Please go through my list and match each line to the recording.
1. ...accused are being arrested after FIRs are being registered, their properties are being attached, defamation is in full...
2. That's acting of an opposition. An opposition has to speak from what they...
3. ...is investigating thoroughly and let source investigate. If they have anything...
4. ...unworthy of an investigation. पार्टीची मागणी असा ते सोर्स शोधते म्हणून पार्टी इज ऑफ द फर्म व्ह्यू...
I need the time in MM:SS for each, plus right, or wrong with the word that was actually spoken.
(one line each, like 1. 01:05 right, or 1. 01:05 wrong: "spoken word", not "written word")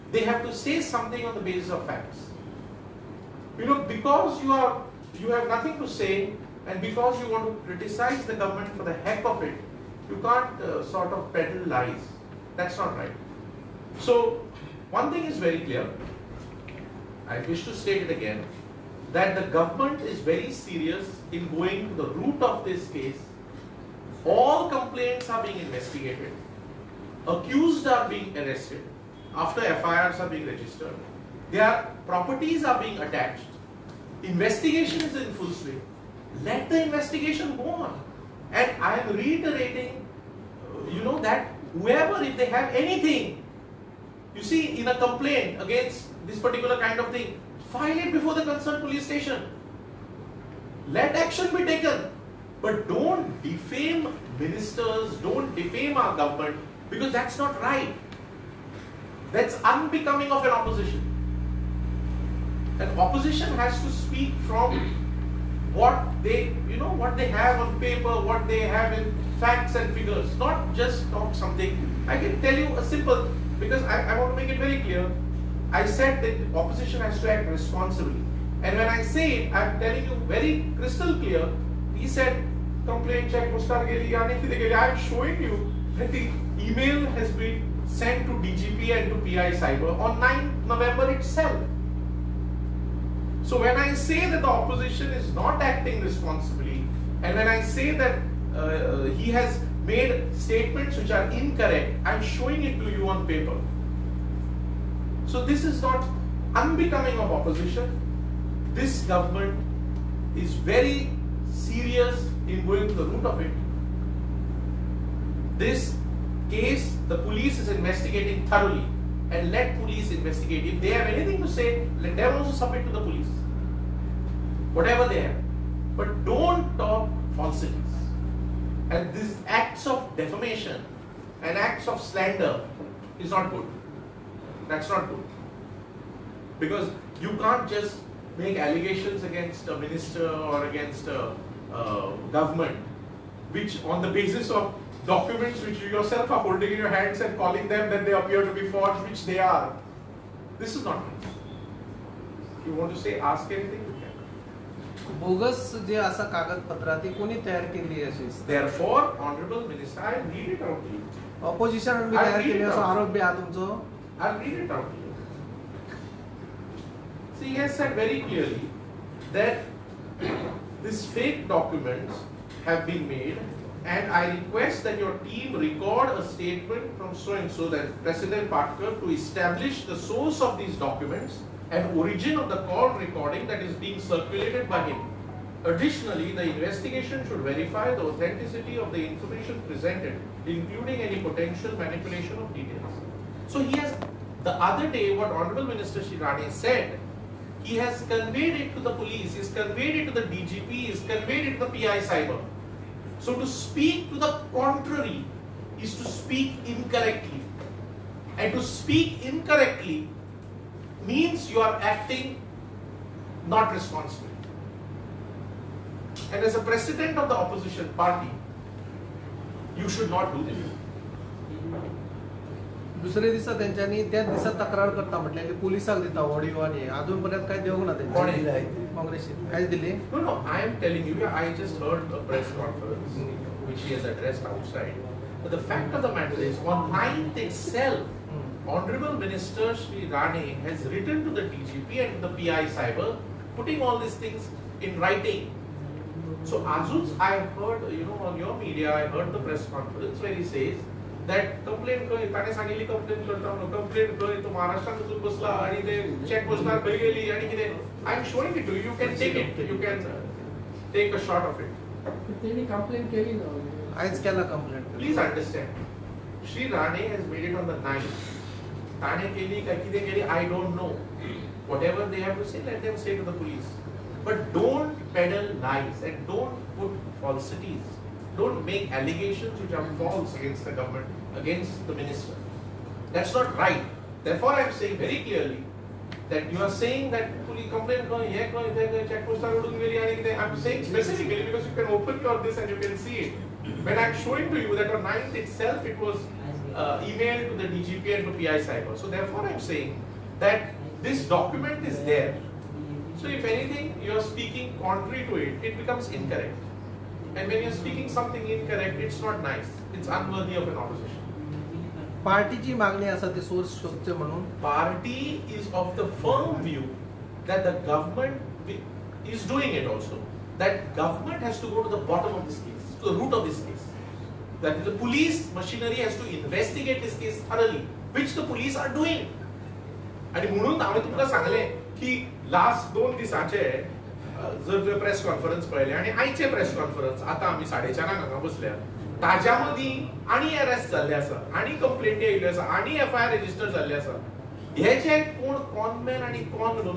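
1. 00:27 wrong: "investigation", not "defamation"
2. 00:59 wrong: "unbecoming", not "acting"
3. 01:57 wrong: "police", not "source"
4. 05:10 wrong: "opposition", not "investigation".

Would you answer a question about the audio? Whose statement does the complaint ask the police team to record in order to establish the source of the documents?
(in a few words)
Patkar.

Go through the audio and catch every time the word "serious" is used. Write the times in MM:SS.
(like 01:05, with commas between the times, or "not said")
00:20, 01:51.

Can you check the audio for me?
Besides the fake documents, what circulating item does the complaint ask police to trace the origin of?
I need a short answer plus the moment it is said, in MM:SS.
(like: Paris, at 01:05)
call recording, at 03:02.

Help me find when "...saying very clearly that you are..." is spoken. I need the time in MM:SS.
04:44.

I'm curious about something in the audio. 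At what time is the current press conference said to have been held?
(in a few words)
4:30.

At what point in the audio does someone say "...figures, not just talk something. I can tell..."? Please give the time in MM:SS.
01:09.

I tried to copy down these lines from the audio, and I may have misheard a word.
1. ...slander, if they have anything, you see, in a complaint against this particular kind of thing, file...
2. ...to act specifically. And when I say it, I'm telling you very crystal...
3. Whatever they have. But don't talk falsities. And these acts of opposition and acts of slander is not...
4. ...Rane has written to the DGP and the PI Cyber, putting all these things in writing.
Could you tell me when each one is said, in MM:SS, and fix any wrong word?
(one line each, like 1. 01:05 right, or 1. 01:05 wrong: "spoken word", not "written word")
1. 00:41 wrong: "whoever", not "slander"
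2. 01:17 wrong: "responsibly", not "specifically"
3. 02:04 wrong: "defamation", not "opposition"
4. 04:00 right.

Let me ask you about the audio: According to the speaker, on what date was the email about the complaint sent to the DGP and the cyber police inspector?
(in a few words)
9 November.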